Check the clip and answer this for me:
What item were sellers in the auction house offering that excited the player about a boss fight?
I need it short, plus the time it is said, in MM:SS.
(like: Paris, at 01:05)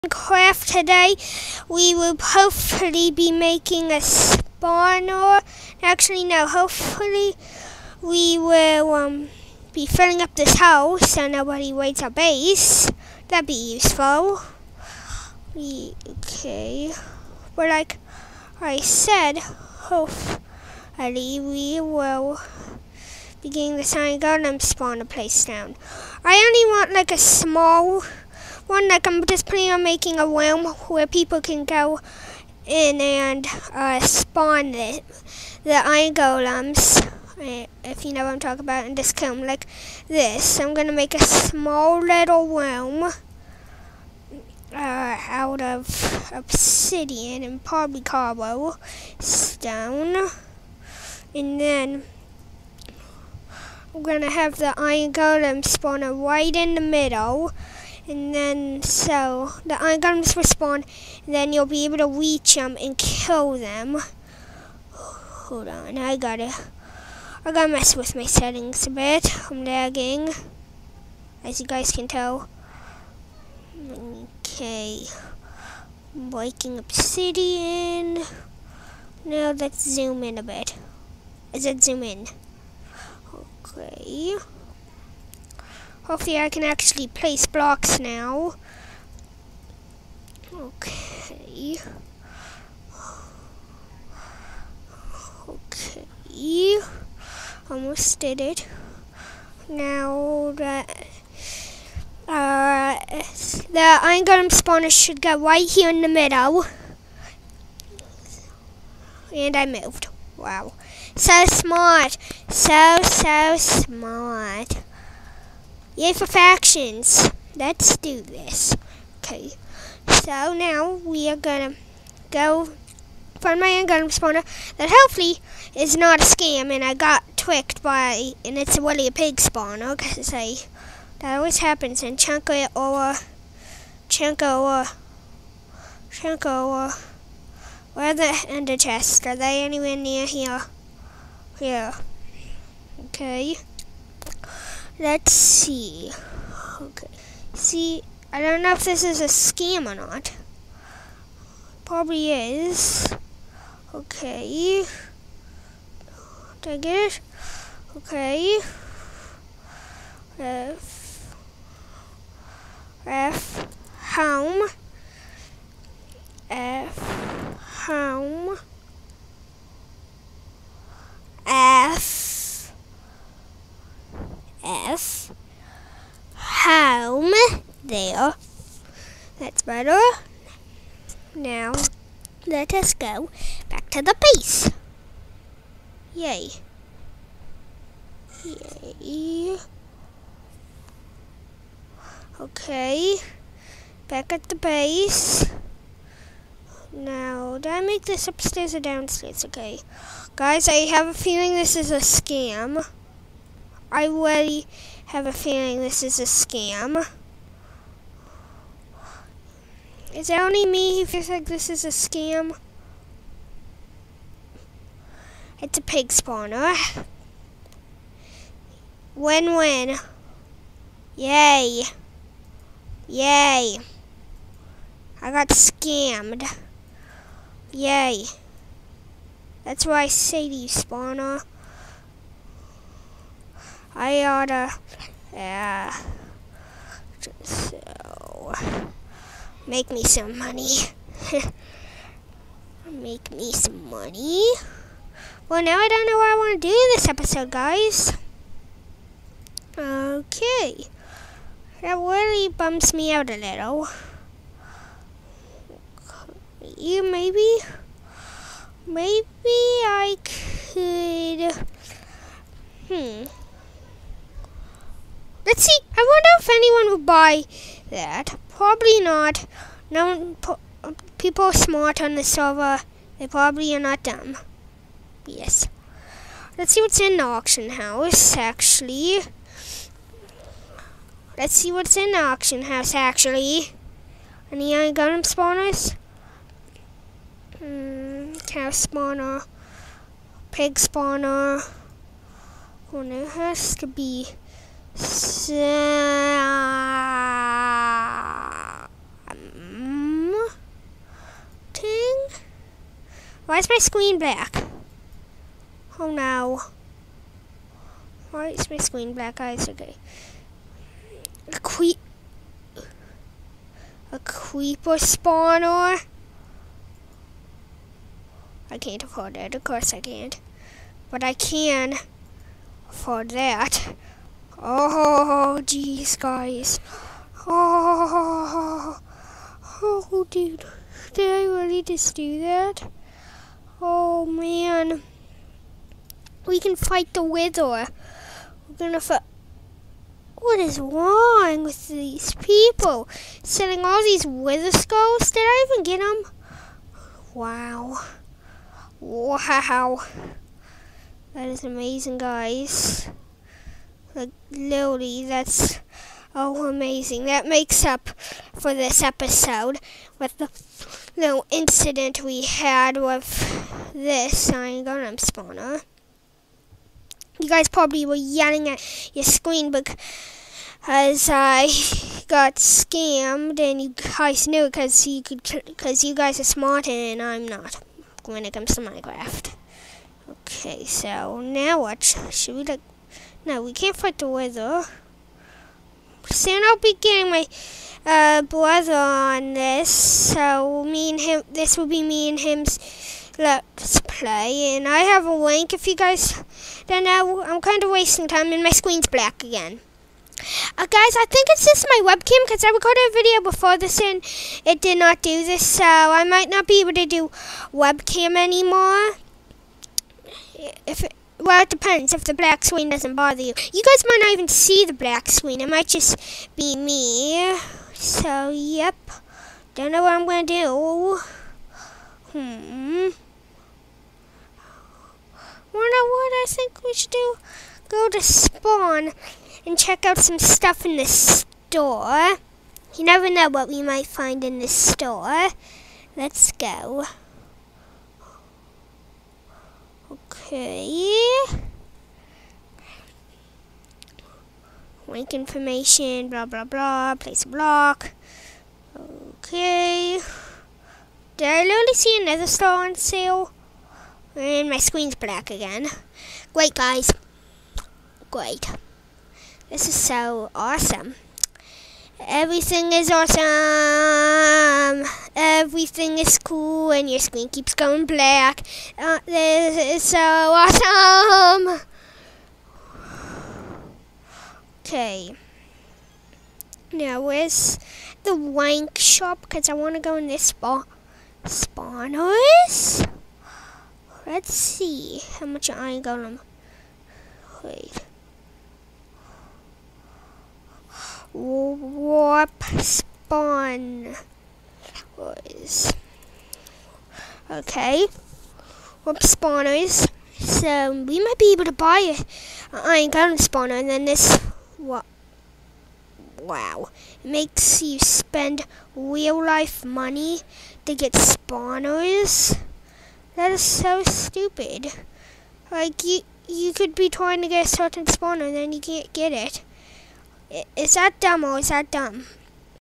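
Wither skulls, at 05:44.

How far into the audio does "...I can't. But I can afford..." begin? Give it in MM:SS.
05:19.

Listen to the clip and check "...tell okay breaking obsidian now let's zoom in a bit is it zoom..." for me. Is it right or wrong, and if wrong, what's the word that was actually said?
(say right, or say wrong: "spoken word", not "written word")
right.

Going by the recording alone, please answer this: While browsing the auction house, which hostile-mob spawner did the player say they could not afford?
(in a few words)
Creeper spawner.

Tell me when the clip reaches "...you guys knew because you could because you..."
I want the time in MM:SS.
06:13.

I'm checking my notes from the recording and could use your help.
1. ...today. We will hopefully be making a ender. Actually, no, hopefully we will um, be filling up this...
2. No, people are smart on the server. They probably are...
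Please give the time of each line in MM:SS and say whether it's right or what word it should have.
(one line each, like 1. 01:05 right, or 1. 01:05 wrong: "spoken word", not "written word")
1. 00:00 wrong: "spawner", not "ender"
2. 04:29 right.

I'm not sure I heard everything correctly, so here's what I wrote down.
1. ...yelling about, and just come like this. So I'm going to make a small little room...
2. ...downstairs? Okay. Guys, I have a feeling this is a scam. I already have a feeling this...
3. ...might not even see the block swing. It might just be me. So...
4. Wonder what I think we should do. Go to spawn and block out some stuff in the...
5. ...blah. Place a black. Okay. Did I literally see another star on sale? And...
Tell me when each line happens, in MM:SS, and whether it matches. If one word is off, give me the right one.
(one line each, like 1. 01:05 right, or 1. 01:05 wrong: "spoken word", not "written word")
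1. 00:38 wrong: "talking", not "yelling"
2. 03:18 right
3. 06:54 wrong: "black", not "block"
4. 07:05 wrong: "check", not "block"
5. 07:26 wrong: "block", not "black".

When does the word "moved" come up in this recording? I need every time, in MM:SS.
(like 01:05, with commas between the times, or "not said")
01:49.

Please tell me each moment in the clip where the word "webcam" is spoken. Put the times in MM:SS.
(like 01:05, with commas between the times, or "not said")
06:42, 06:47.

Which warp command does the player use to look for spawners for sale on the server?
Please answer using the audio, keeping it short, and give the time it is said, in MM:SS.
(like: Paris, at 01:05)
warp spawners, at 08:19.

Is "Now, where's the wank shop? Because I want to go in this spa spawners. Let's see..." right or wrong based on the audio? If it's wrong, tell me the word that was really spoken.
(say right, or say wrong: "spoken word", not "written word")
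right.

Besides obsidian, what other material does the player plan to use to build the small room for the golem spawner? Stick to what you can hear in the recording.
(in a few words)
Cobblestone.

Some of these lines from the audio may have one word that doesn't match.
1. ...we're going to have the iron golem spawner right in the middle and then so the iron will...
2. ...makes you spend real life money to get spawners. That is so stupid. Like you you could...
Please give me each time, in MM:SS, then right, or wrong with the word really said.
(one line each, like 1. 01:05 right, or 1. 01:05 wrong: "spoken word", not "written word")
1. 00:53 right
2. 08:27 right.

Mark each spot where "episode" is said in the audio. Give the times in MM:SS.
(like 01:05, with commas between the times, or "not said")
04:07, 05:59.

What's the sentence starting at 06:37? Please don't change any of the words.
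I'm kind of wasting time, and my screen's black again.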